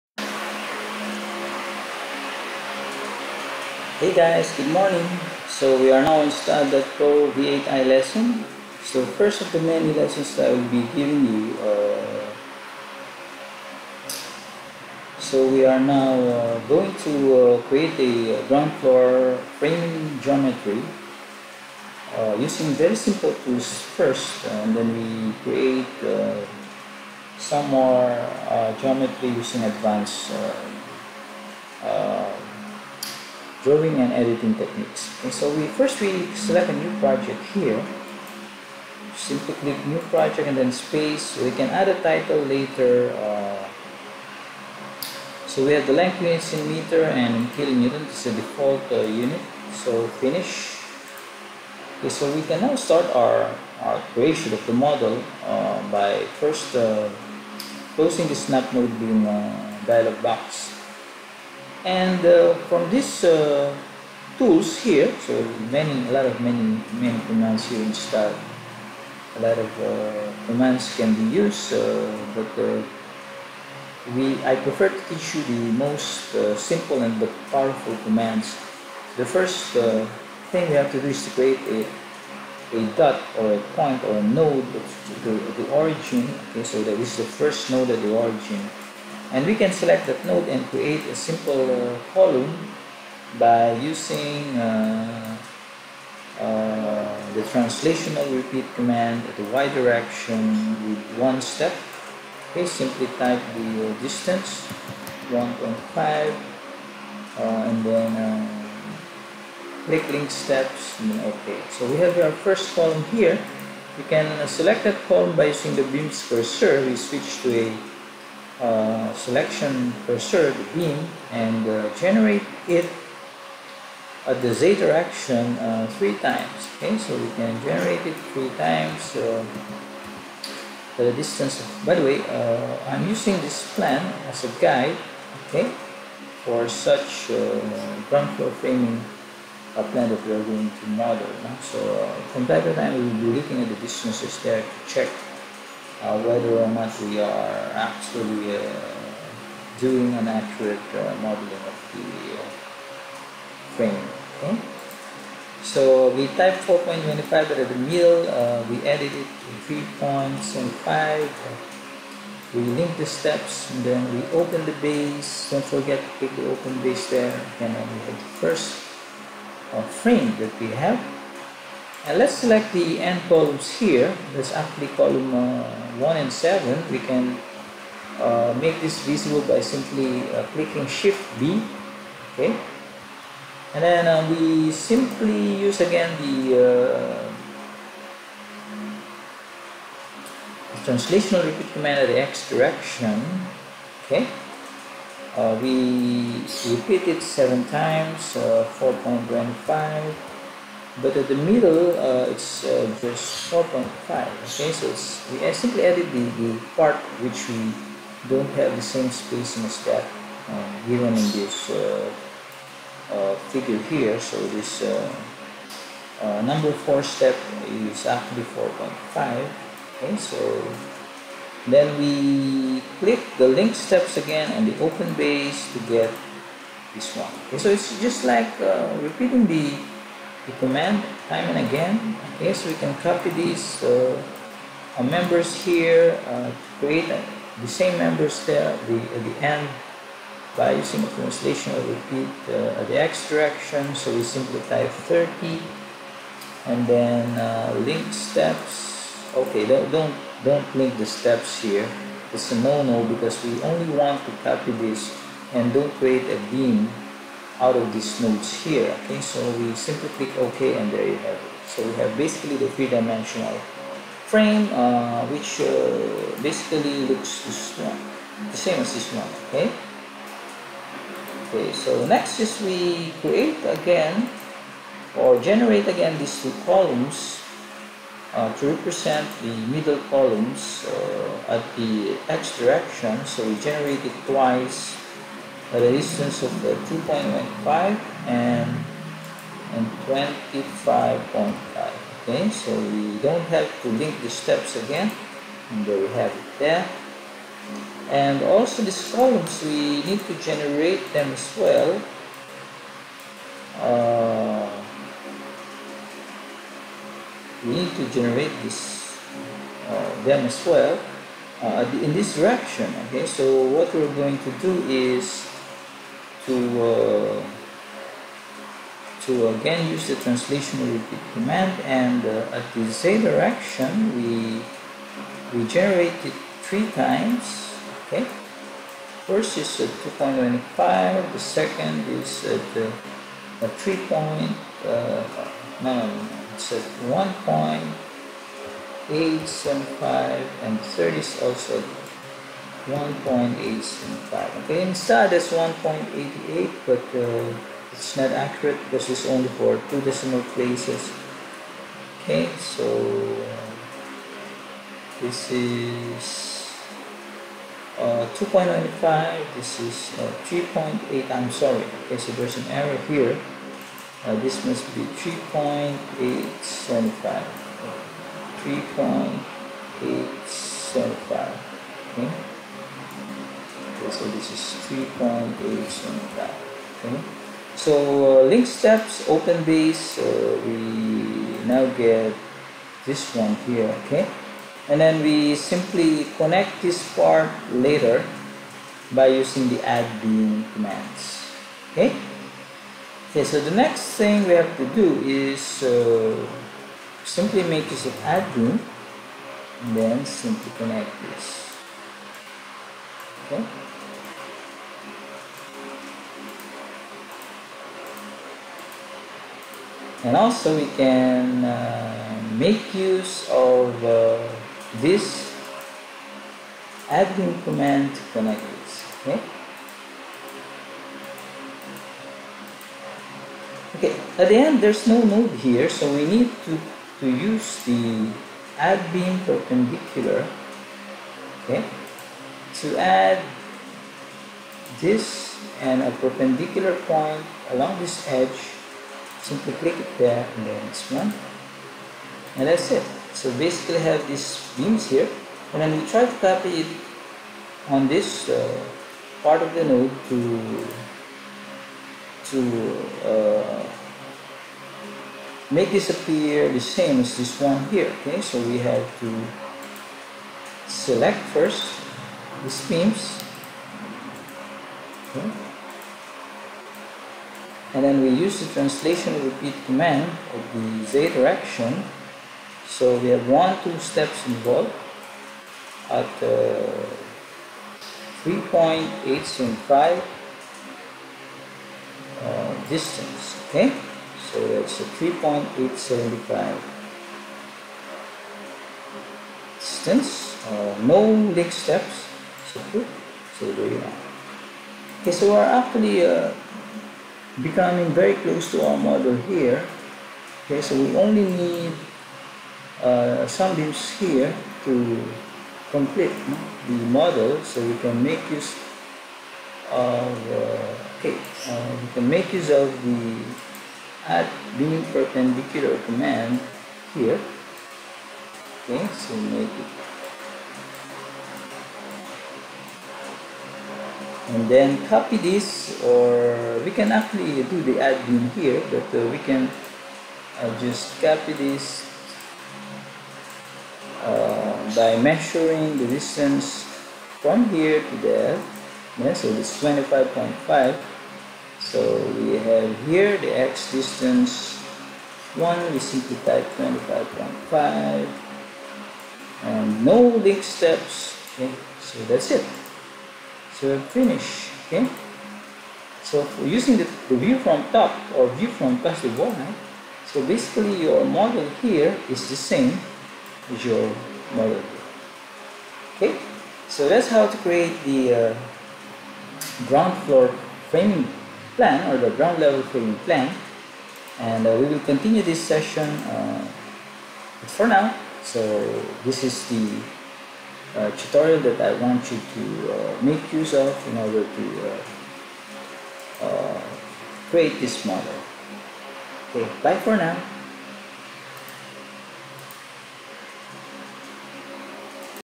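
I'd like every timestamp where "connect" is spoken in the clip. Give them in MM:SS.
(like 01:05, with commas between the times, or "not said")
06:26, 06:40, 06:58.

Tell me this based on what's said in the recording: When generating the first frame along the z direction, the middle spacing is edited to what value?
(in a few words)
3.25.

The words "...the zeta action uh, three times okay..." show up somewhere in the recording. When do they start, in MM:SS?
02:04.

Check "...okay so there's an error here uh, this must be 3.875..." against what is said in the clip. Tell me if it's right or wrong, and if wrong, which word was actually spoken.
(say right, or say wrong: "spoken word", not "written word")
right.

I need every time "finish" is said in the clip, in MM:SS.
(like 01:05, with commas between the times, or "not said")
00:50, 09:14.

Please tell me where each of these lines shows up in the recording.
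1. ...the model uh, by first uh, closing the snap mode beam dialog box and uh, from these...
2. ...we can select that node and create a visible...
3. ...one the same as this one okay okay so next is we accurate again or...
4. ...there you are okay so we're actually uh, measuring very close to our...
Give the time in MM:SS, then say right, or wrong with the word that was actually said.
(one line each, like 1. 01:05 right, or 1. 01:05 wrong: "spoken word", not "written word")
1. 00:54 right
2. 01:29 wrong: "simple", not "visible"
3. 04:27 wrong: "create", not "accurate"
4. 08:13 wrong: "becoming", not "measuring".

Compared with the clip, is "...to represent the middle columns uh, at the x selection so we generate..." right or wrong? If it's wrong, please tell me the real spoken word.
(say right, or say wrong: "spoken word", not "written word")
wrong: "direction", not "selection".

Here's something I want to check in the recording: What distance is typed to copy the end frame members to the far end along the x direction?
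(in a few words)
30.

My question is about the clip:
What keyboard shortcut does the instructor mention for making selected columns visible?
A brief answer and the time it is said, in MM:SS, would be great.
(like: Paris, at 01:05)
shift B, at 03:00.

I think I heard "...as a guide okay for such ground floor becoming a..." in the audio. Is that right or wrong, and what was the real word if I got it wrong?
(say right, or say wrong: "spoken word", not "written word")
wrong: "framing", not "becoming".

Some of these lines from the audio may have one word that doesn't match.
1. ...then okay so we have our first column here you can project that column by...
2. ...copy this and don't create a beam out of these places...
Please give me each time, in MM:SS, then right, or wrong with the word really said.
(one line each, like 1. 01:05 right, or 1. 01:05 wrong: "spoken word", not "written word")
1. 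01:51 wrong: "select", not "project"
2. 04:14 wrong: "nodes", not "places".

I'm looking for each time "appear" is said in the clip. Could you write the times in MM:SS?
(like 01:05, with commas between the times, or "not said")
07:36.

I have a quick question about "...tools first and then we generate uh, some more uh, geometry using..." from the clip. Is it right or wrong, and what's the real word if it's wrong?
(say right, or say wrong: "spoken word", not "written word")
wrong: "create", not "generate".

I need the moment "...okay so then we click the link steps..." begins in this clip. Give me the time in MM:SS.
03:39.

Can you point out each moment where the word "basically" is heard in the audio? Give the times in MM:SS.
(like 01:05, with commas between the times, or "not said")
04:22, 04:26, 07:23, 09:20.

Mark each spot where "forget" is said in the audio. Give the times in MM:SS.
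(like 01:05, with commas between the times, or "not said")
02:45.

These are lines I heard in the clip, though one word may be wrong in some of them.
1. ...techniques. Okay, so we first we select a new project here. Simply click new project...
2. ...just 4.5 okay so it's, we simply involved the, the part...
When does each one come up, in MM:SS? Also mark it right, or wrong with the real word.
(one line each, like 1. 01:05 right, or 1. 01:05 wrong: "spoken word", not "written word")
1. 00:34 right
2. 03:22 wrong: "added", not "involved".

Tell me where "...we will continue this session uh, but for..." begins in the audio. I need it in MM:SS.
09:34.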